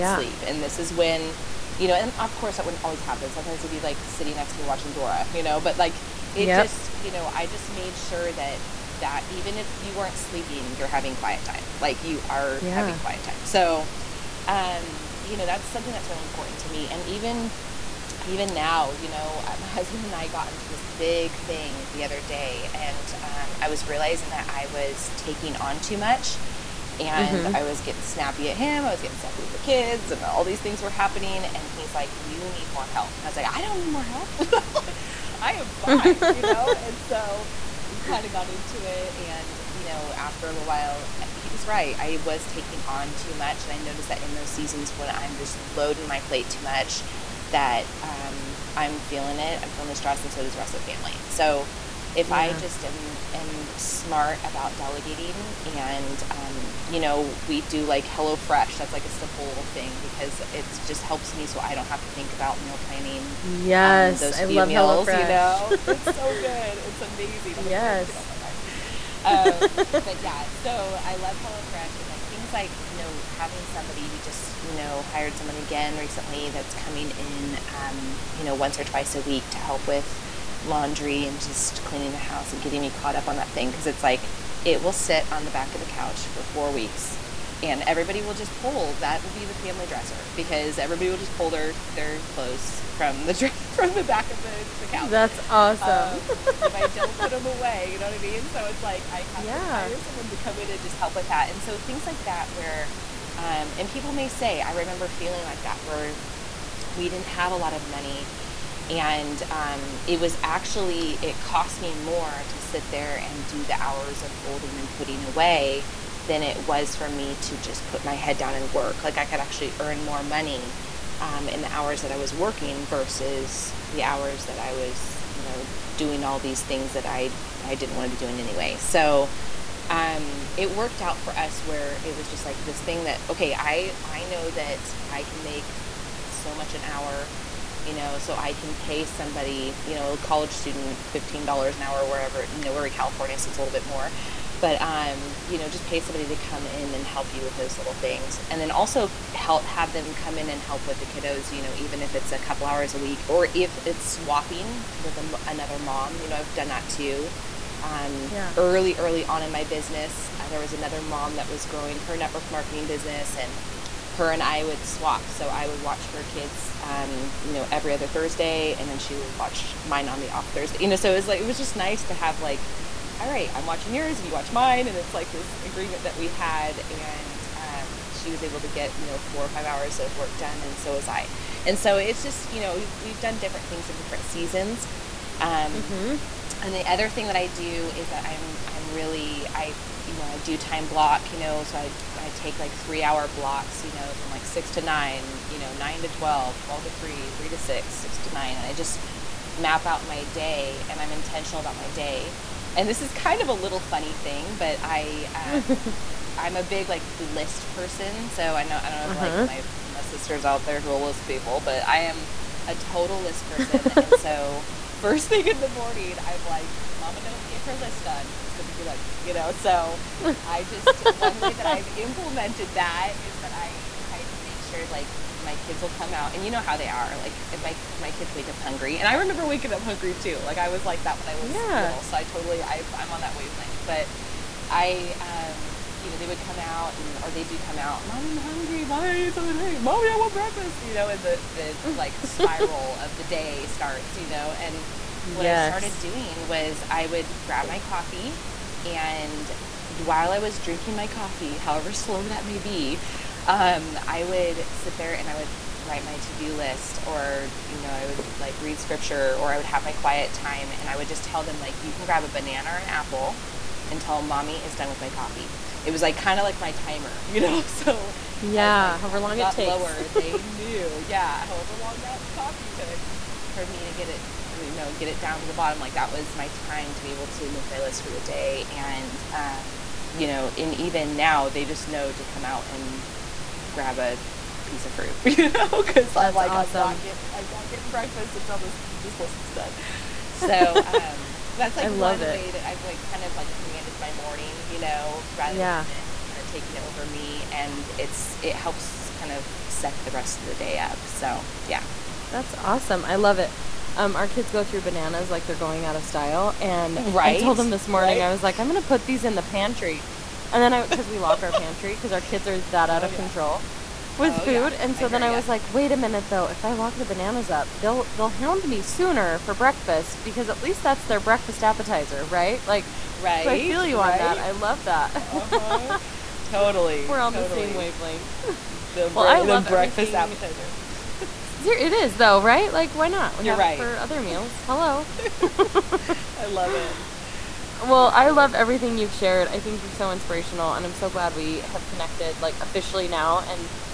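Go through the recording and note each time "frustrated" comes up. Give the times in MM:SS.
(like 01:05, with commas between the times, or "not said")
not said.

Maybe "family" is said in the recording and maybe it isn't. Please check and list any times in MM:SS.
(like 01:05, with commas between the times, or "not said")
00:50, 01:29.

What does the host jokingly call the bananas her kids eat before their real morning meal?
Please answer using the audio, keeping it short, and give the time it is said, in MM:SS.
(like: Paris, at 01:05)
breakfast appetizer, at 05:21.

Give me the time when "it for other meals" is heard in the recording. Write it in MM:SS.
05:33.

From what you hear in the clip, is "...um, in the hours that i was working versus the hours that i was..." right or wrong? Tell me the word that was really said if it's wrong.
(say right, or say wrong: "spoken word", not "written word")
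right.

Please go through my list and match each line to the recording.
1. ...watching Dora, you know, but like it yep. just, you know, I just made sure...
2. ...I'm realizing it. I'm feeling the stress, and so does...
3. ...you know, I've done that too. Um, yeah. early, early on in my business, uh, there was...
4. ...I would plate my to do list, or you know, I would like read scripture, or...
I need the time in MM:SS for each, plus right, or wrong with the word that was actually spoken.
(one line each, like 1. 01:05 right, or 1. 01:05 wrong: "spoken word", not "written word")
1. 00:04 right
2. 00:48 wrong: "feeling", not "realizing"
3. 02:36 right
4. 04:15 wrong: "write", not "plate".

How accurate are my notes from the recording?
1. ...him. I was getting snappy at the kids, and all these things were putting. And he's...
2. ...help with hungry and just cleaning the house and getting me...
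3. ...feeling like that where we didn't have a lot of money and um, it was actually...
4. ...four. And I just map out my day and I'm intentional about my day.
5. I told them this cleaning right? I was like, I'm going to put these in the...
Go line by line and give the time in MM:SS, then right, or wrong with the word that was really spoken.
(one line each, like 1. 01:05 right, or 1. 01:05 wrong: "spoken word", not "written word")
1. 00:28 wrong: "happening", not "putting"
2. 01:19 wrong: "laundry", not "hungry"
3. 01:45 right
4. 03:18 wrong: "nine", not "four"
5. 05:07 wrong: "morning", not "cleaning".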